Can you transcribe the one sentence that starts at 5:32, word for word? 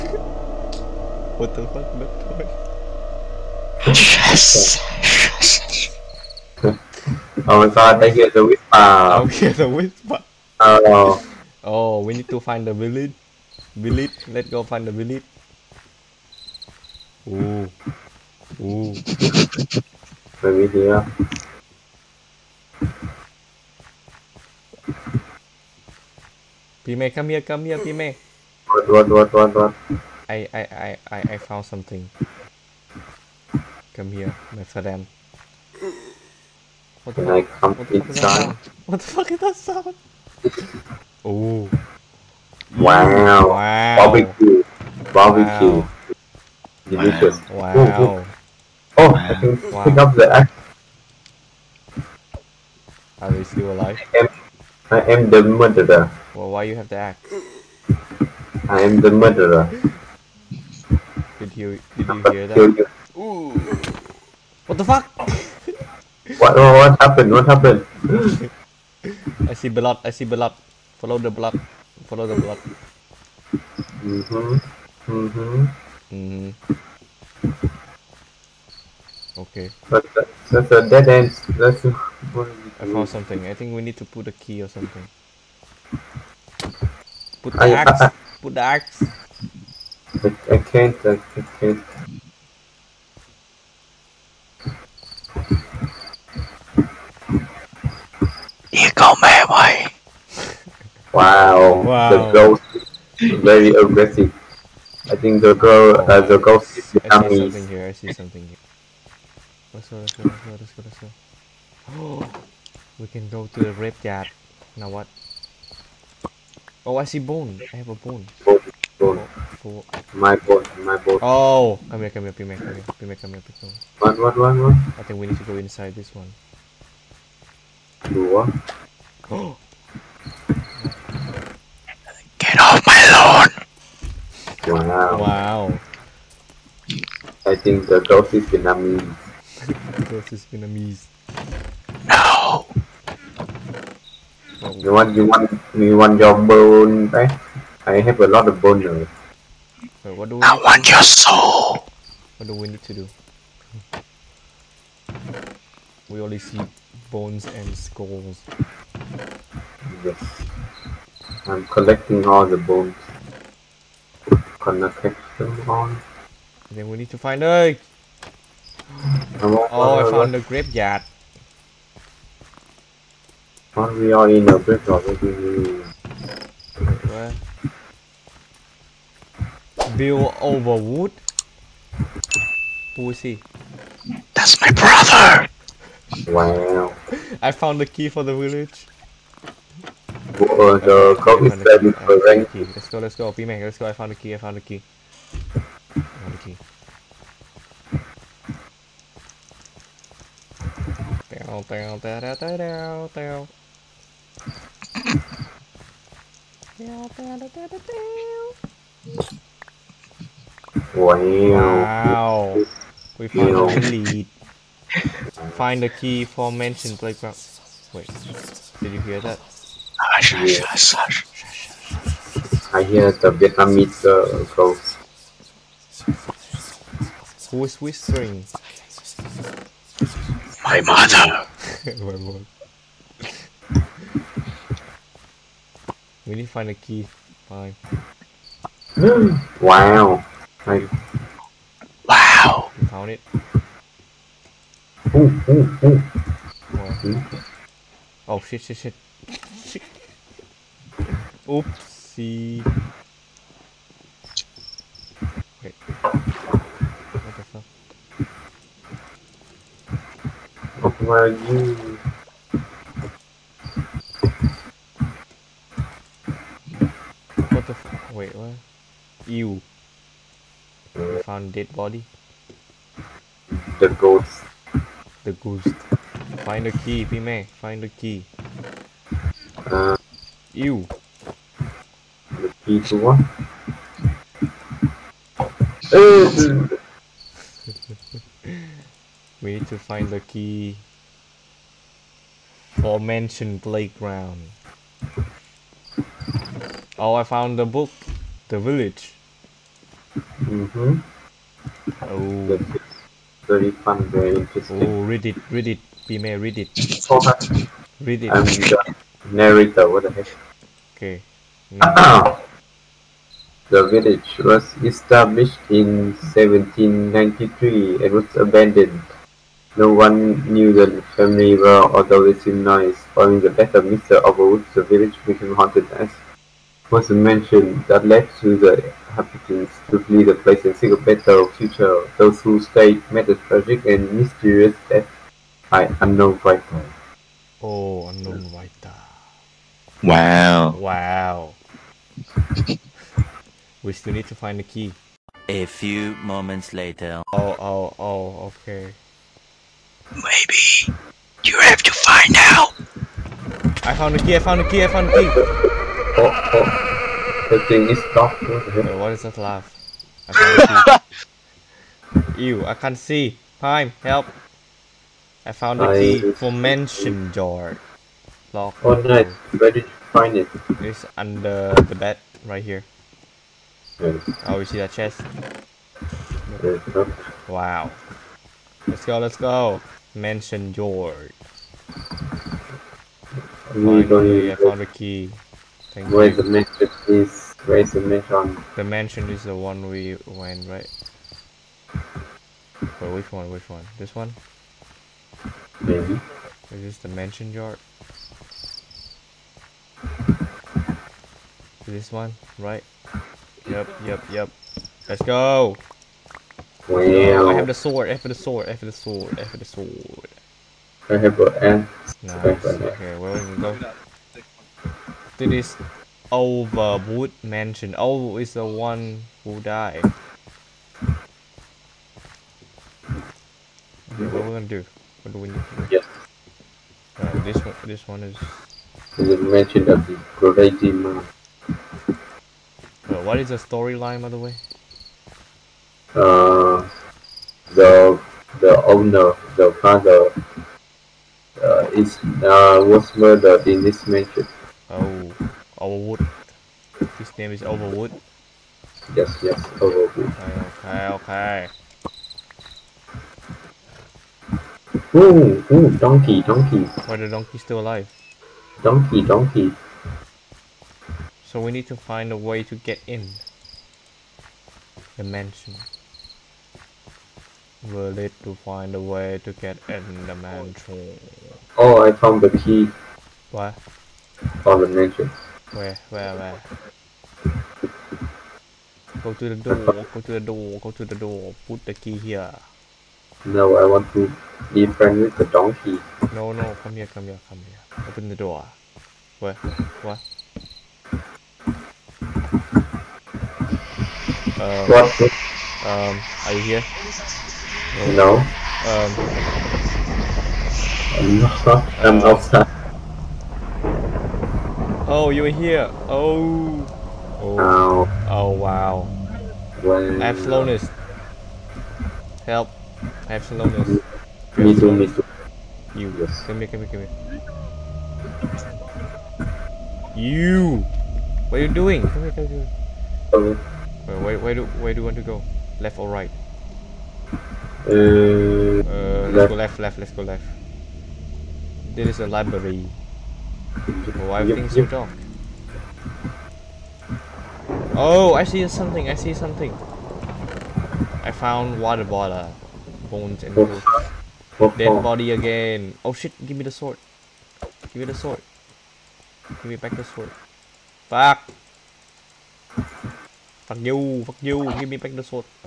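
Those who stayed met a tragic and mysterious death by unknown writer.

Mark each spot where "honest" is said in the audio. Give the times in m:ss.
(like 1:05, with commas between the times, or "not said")
not said.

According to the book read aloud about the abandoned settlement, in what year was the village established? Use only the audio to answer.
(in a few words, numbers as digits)
1793.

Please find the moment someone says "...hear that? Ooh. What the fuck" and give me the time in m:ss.
1:02.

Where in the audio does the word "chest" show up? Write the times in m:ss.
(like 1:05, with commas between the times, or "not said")
6:14.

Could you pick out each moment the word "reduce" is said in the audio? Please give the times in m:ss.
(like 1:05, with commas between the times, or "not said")
not said.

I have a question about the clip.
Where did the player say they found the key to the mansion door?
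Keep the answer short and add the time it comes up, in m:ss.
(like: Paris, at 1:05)
Under the bed, at 6:11.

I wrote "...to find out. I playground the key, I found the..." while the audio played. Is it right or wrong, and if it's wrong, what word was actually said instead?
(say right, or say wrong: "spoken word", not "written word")
wrong: "found", not "playground".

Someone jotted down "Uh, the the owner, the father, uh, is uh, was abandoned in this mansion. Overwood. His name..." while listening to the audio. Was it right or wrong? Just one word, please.
wrong.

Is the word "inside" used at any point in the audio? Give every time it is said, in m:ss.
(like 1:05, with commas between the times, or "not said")
2:05.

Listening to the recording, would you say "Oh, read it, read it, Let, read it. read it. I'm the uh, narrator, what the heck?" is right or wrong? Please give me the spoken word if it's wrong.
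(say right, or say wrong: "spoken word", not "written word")
wrong: "Pime", not "Let".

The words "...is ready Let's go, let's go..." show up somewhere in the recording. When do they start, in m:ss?
3:11.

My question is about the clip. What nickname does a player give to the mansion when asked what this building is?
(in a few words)
The Mansion of the Crazy Man.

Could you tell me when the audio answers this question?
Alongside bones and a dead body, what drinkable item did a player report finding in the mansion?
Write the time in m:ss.
9:01.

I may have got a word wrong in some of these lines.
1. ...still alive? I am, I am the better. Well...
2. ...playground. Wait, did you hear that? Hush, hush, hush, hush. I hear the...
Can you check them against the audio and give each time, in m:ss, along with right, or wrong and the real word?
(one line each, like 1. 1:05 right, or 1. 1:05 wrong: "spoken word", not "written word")
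1. 0:53 wrong: "murderer", not "better"
2. 3:36 right.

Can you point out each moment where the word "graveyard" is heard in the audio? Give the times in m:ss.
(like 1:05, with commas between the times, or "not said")
2:50, 2:54.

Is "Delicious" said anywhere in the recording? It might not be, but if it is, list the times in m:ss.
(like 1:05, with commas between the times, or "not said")
0:46.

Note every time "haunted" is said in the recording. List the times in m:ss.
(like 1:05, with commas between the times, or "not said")
5:25.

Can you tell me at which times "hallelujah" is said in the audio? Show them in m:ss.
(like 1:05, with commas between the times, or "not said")
not said.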